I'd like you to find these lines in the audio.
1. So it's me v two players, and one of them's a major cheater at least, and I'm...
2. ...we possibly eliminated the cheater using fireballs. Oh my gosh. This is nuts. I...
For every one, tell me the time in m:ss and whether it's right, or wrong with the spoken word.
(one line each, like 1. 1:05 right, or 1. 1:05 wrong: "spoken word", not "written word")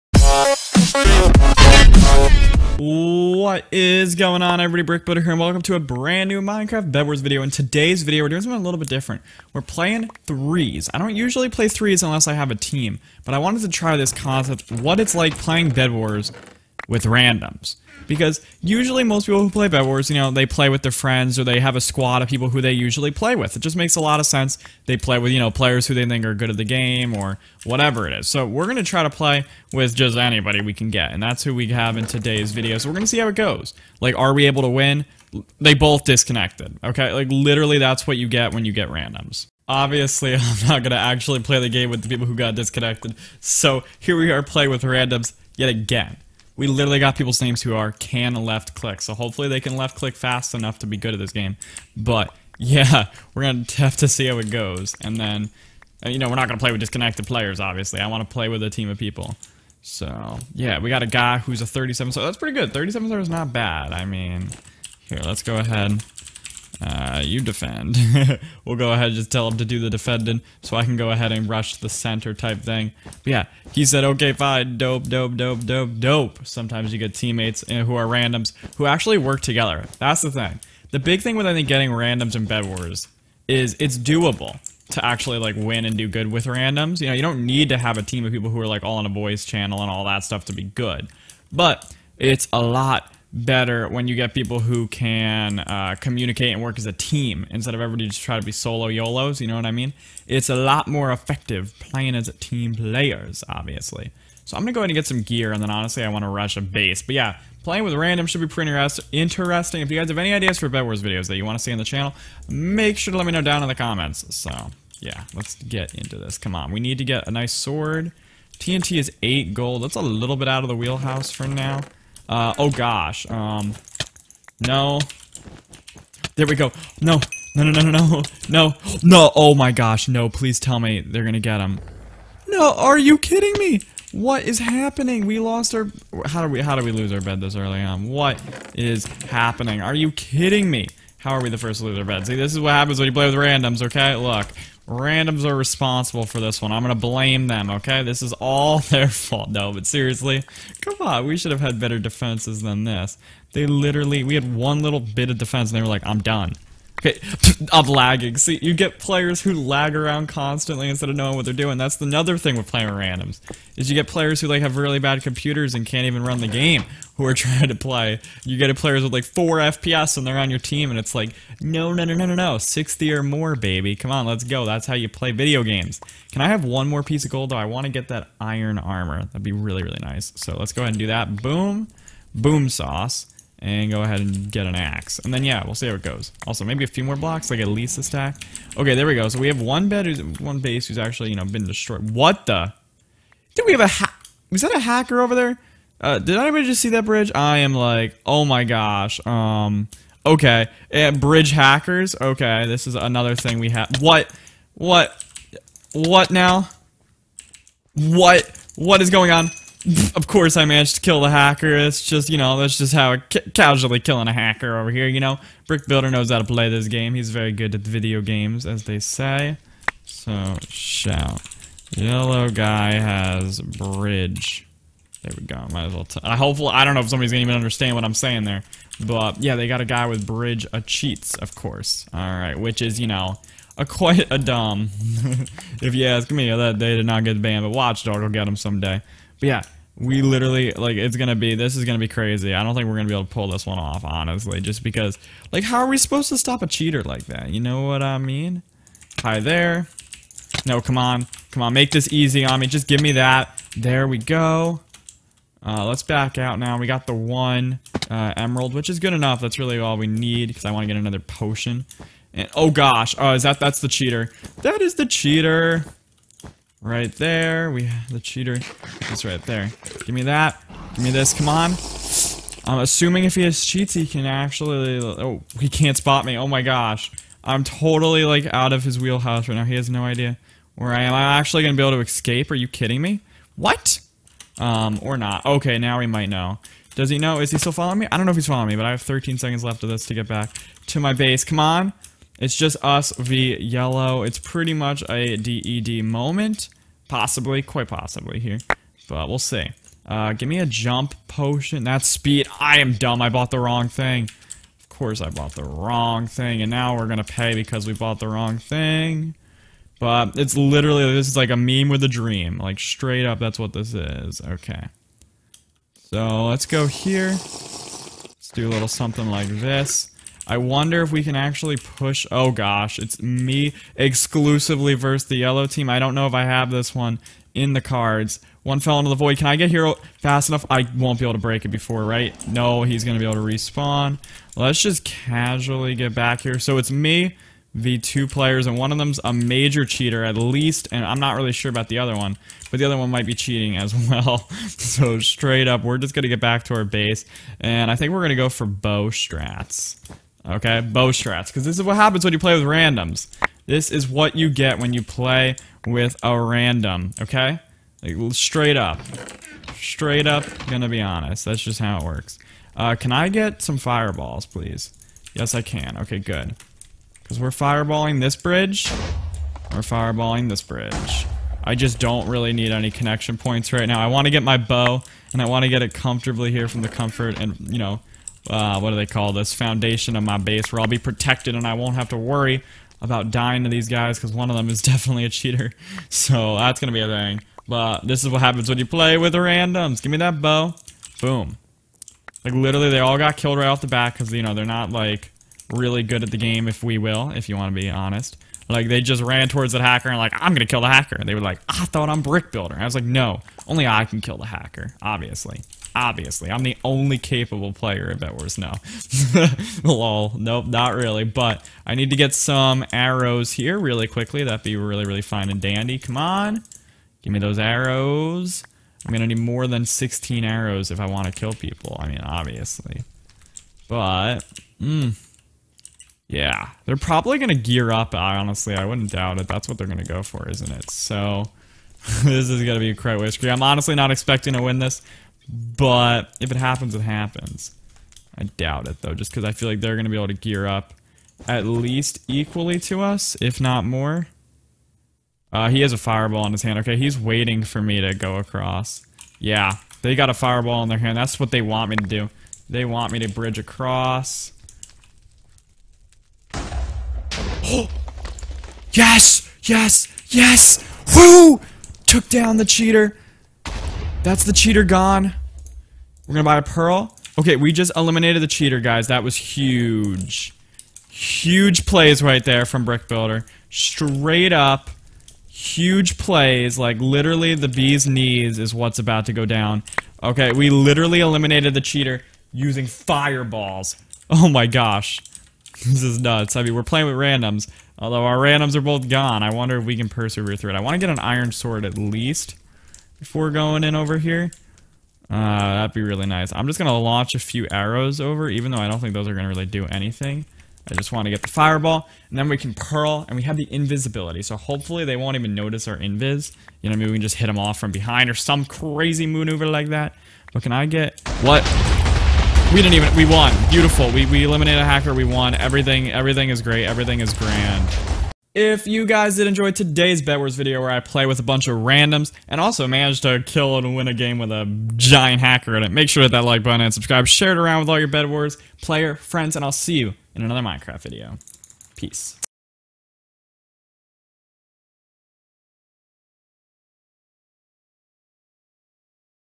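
1. 5:36 right
2. 8:00 wrong: "literally", not "possibly".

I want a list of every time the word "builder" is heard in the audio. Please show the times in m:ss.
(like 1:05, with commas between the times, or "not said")
0:05, 3:35, 6:42, 7:53.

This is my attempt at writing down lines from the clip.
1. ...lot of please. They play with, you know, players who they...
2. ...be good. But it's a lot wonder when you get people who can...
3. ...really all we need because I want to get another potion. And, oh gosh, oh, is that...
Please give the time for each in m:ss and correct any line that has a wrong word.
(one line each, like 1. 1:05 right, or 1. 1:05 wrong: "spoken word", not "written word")
1. 0:24 wrong: "sense", not "please"
2. 1:30 wrong: "better", not "wonder"
3. 4:19 right.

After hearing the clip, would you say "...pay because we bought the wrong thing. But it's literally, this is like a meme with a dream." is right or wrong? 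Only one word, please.
right.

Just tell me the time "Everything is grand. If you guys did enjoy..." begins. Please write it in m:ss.
8:36.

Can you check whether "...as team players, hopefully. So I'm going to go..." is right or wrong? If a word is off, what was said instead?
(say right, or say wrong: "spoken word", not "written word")
wrong: "obviously", not "hopefully".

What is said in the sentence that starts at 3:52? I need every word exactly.
All right, which is you know a quite a dumb.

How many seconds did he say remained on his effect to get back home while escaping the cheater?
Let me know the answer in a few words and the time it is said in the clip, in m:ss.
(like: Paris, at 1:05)
13, at 4:49.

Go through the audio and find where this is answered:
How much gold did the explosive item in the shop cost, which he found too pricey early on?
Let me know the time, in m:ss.
1:59.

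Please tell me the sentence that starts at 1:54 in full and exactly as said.
So yeah, let's get into this.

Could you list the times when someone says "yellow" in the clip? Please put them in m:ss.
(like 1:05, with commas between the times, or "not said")
3:41, 4:53, 5:25.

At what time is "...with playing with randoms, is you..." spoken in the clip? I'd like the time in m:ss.
2:42.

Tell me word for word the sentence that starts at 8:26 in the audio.
You know, maybe we can just hit them off from behind or some crazy maneuver like that.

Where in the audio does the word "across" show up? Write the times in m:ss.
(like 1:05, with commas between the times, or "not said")
7:28, 7:33.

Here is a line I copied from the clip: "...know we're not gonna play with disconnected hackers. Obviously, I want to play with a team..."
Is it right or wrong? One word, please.
wrong.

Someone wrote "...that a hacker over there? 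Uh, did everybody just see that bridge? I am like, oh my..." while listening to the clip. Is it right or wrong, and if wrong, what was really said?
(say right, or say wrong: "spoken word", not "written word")
wrong: "anybody", not "everybody".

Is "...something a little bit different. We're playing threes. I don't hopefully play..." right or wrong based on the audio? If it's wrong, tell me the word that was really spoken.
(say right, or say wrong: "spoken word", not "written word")
wrong: "usually", not "hopefully".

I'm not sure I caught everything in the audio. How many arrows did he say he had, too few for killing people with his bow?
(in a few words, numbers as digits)
16.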